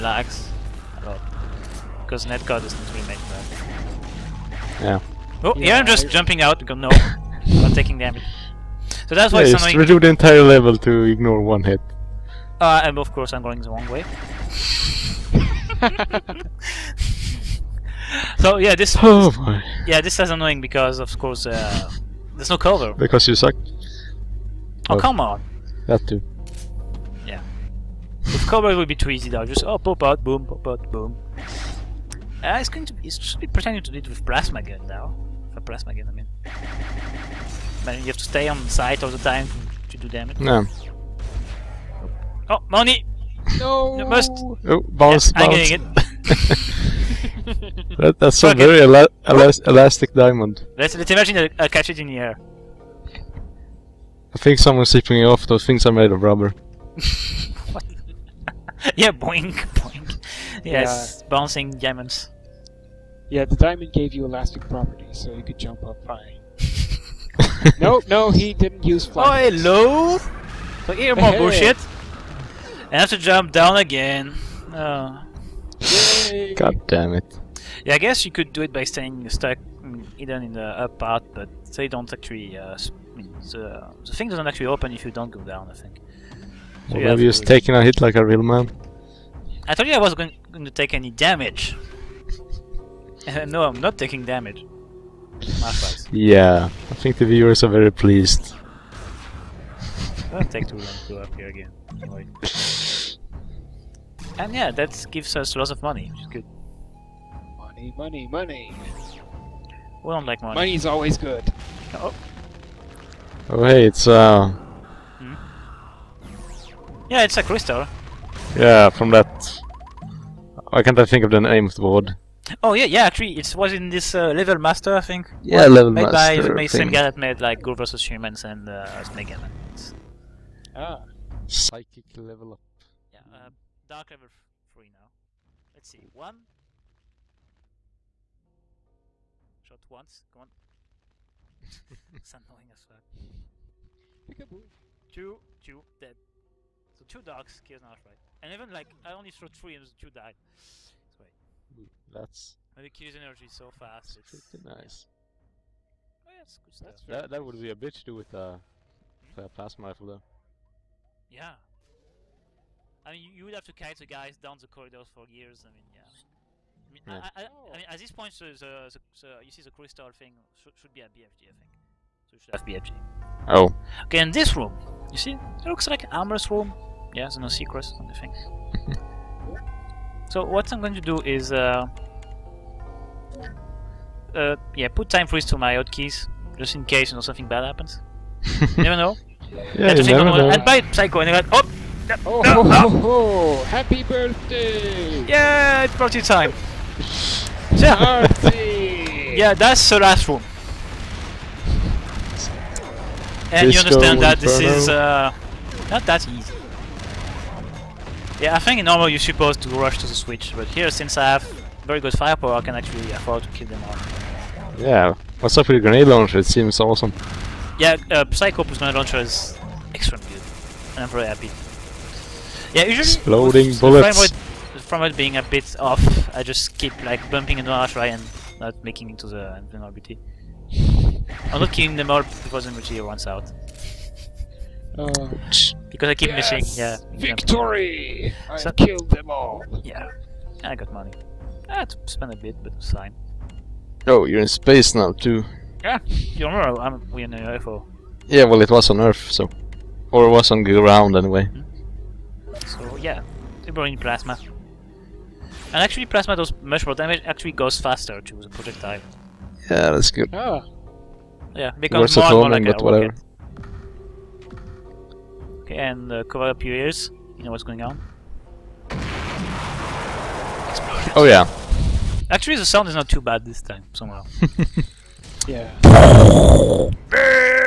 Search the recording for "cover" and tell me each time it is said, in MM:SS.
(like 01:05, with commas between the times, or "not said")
00:22, 00:28, 04:26.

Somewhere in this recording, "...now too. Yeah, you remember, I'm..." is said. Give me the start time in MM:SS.
04:04.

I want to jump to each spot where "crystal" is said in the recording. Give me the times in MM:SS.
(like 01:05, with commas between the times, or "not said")
01:57, 02:49.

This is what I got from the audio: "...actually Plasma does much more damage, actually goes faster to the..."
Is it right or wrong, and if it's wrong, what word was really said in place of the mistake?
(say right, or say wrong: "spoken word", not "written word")
right.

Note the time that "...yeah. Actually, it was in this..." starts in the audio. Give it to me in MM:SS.
02:02.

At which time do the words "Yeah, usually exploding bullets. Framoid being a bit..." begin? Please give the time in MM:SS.
03:42.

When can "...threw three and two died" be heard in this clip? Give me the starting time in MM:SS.
02:29.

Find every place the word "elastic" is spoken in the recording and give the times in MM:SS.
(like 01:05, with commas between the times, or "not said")
00:49, 01:04.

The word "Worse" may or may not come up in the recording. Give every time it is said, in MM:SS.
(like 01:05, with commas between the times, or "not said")
04:22.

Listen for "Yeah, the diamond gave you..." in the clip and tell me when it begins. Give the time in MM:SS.
01:03.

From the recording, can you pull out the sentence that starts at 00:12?
Uh, and of course I'm going the wrong way.